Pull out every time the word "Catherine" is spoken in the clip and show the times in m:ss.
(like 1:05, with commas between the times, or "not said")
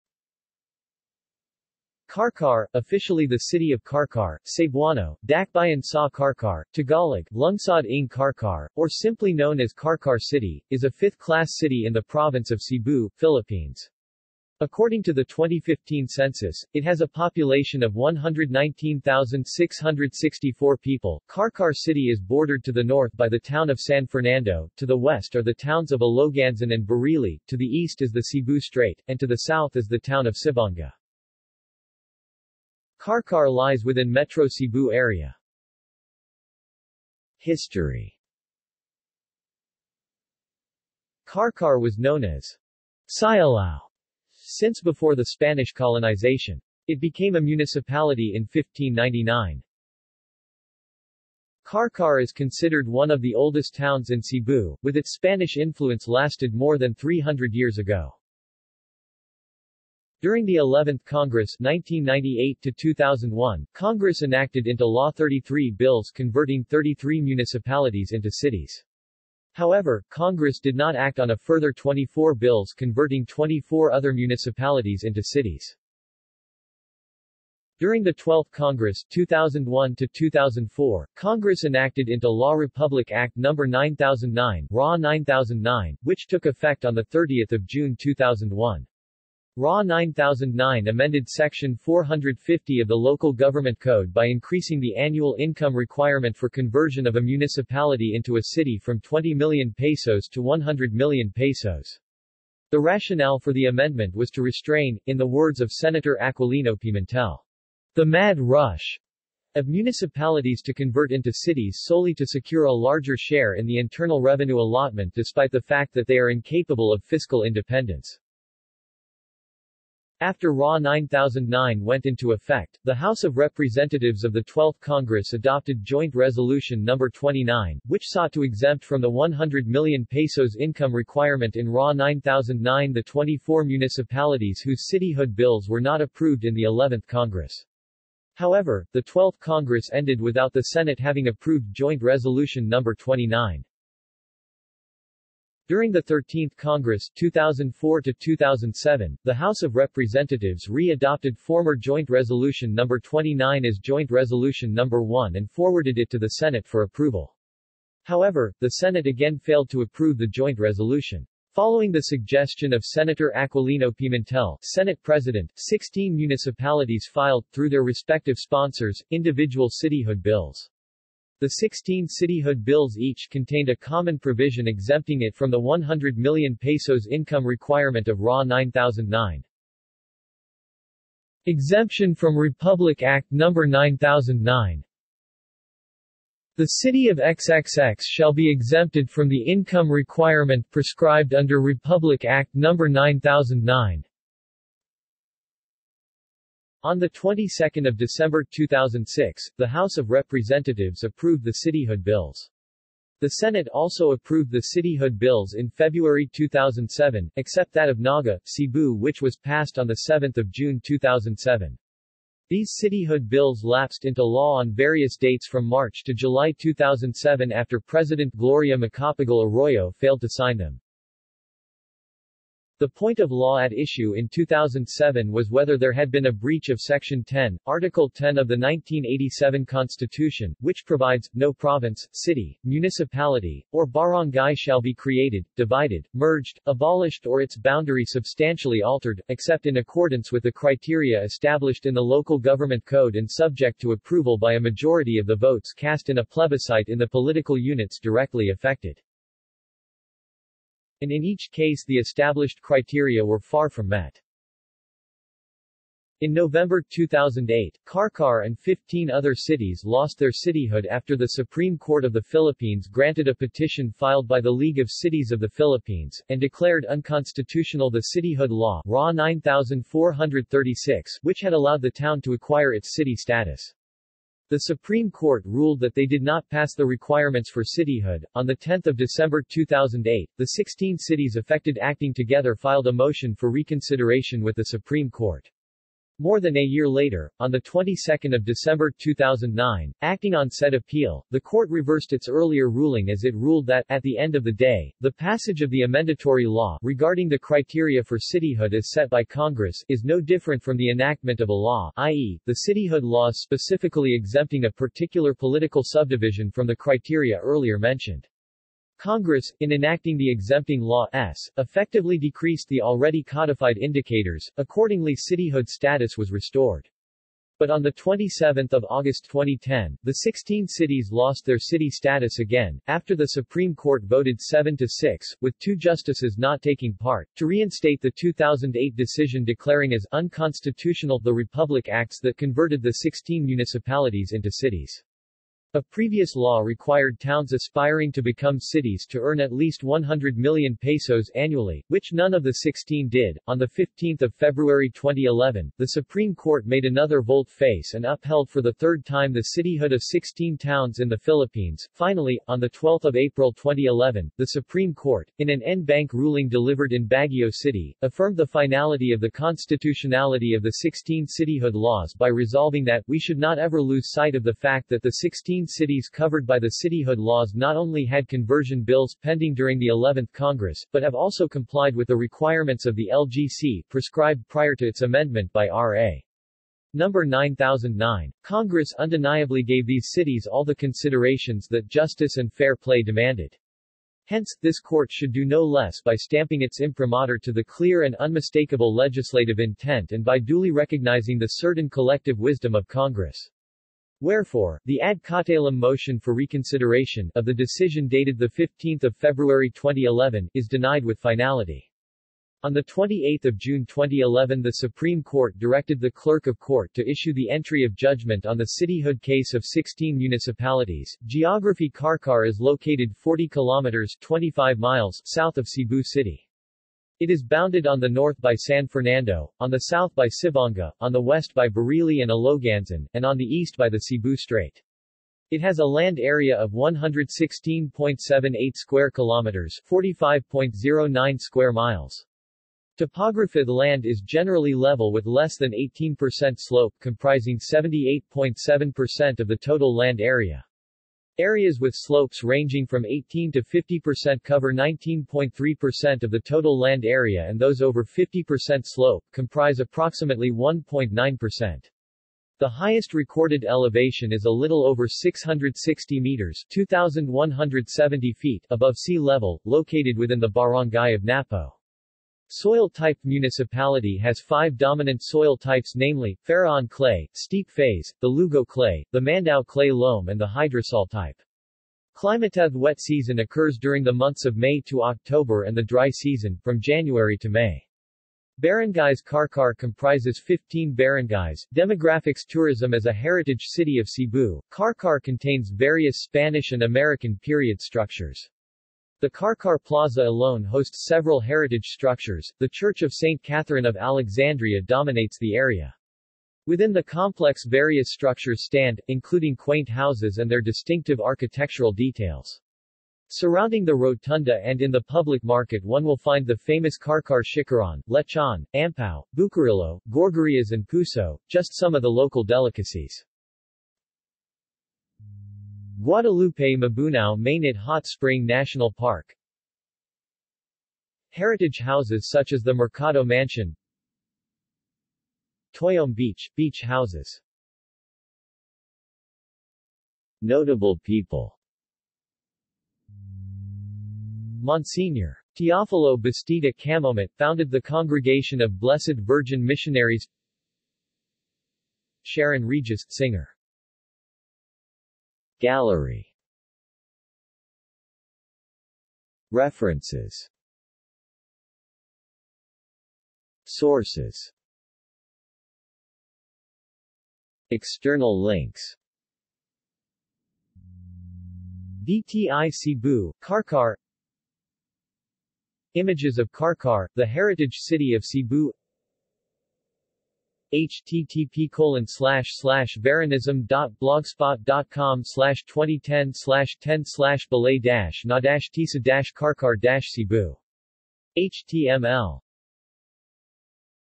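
8:13.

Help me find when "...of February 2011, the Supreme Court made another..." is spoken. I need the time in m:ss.
5:44.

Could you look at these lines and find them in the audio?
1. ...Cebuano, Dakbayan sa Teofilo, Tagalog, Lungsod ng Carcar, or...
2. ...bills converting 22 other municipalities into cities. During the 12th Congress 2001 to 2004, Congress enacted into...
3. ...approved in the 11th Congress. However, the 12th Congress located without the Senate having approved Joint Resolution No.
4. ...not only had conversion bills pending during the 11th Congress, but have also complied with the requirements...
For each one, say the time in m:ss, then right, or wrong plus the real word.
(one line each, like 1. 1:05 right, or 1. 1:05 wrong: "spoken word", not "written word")
1. 0:04 wrong: "Carcar", not "Teofilo"
2. 1:12 wrong: "24", not "22"
3. 2:16 wrong: "ended", not "located"
4. 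6:07 right.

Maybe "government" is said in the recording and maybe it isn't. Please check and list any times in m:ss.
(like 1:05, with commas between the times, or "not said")
1:33, 4:02.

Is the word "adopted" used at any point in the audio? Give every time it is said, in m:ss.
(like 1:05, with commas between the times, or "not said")
2:05, 2:30.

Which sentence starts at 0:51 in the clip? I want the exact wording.
Carcar is considered one of the oldest towns in Cebu, with its Spanish influence lasted more than 300 years ago.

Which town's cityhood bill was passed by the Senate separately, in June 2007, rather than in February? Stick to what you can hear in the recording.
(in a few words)
Naga, Cebu.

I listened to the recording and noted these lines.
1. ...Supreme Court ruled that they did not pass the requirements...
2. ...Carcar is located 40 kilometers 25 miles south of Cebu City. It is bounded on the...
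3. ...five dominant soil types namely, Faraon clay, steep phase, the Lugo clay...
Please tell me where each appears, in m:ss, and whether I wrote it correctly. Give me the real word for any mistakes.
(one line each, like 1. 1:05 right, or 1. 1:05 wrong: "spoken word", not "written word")
1. 4:34 right
2. 6:51 right
3. 7:44 right.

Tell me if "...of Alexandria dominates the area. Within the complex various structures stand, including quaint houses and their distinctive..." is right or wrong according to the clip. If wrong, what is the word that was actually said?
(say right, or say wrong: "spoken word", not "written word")
right.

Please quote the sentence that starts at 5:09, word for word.
Congress, in enacting the Exempting Law S, effectively decreased the already codified indicators, accordingly cityhood status was restored.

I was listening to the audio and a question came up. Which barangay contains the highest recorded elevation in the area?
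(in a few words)
Napo.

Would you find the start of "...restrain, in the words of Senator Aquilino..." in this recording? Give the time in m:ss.
1:44.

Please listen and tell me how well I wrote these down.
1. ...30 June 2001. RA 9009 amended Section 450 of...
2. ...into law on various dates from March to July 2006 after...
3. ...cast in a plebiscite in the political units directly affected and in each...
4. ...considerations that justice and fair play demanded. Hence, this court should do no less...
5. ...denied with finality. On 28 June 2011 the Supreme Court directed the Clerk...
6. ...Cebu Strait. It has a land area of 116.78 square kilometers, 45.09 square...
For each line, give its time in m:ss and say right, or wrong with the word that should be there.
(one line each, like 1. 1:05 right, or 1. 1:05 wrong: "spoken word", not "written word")
1. 1:27 right
2. 3:34 wrong: "2007", not "2006"
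3. 4:05 right
4. 6:20 right
5. 6:40 right
6. 7:03 right.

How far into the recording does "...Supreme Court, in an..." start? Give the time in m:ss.
5:54.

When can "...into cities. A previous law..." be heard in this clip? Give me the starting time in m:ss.
5:34.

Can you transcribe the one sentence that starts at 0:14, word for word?
According to the 2015 census, it has a population of 119,664 people.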